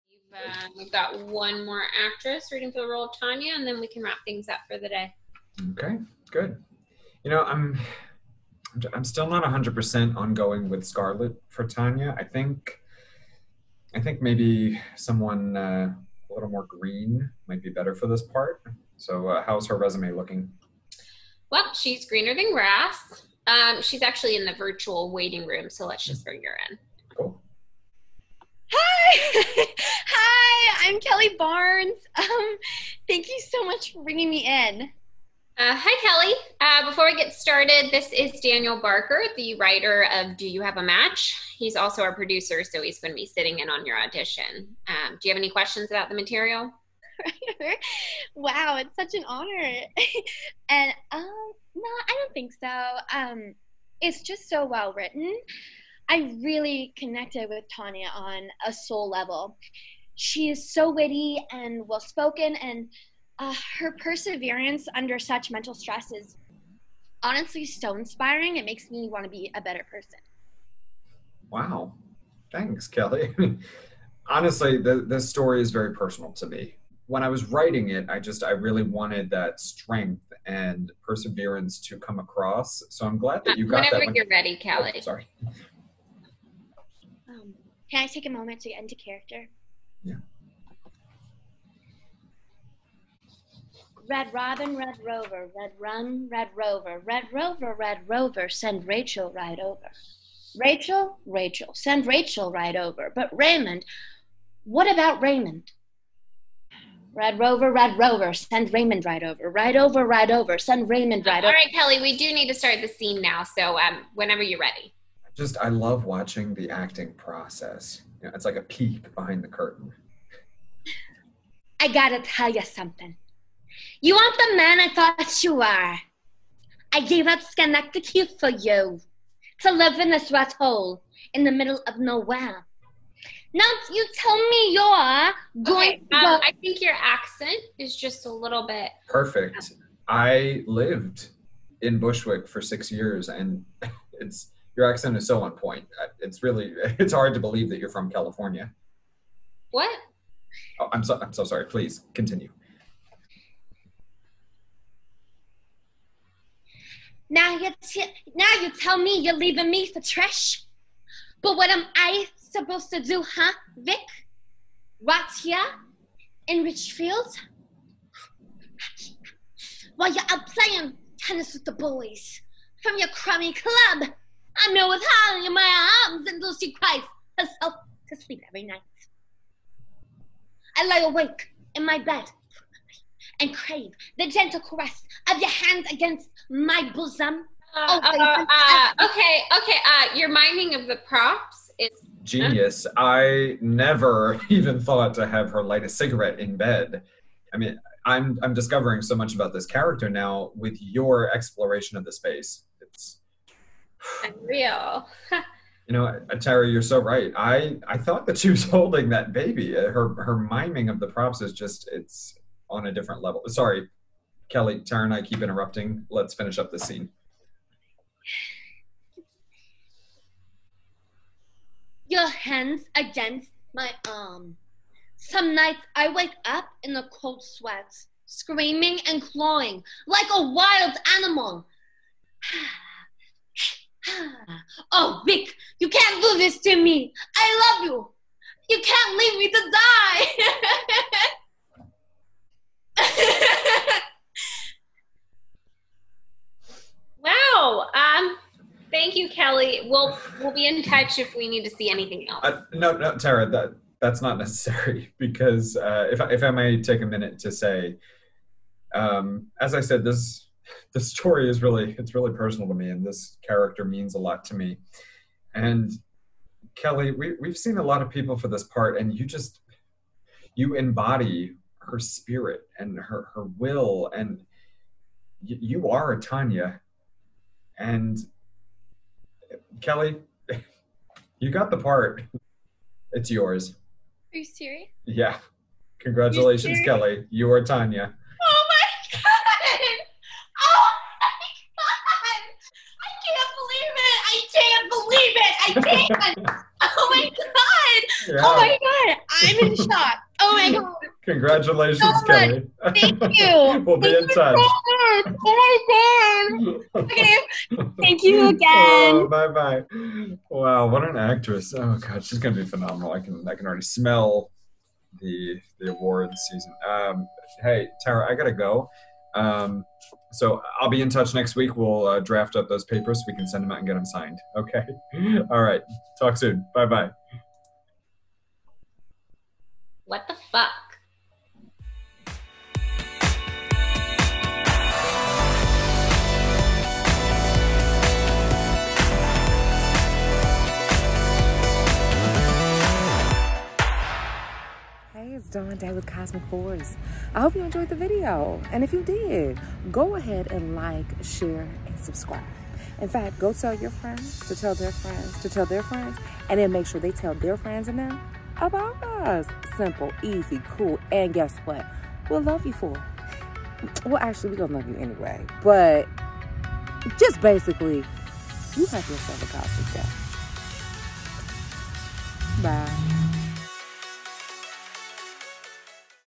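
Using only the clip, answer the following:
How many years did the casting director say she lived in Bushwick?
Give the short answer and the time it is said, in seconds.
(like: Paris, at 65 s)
6, at 142 s.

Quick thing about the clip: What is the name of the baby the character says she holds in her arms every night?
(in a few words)
Holly.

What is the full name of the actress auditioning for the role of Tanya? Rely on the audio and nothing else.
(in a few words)
Kelly Barnes.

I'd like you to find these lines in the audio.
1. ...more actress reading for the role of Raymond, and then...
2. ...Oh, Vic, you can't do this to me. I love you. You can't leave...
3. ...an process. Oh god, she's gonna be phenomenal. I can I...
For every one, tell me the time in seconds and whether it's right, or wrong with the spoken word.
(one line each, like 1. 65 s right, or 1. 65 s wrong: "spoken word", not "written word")
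1. 1 s wrong: "Tanya", not "Raymond"
2. 234 s right
3. 311 s wrong: "actress", not "process".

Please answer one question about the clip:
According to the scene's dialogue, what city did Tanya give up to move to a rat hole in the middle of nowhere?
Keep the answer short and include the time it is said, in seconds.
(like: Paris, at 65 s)
Schenectady, at 127 s.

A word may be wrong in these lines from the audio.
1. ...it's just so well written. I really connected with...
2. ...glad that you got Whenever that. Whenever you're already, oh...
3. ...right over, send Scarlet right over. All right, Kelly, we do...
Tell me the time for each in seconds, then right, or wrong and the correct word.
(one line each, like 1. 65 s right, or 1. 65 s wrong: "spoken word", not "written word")
1. 54 s right
2. 83 s wrong: "ready", not "already"
3. 110 s wrong: "Raymond", not "Scarlet".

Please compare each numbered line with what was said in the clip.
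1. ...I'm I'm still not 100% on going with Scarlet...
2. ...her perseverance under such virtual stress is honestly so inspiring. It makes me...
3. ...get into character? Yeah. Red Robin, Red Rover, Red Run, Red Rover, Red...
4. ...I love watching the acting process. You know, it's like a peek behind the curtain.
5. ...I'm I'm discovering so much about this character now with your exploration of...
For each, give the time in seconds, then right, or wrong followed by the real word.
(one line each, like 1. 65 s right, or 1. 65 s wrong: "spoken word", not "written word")
1. 7 s right
2. 63 s wrong: "mental", not "virtual"
3. 88 s right
4. 115 s right
5. 198 s right.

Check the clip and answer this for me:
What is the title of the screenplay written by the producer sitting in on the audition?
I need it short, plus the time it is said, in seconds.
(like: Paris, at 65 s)
Do You Have a Match?, at 40 s.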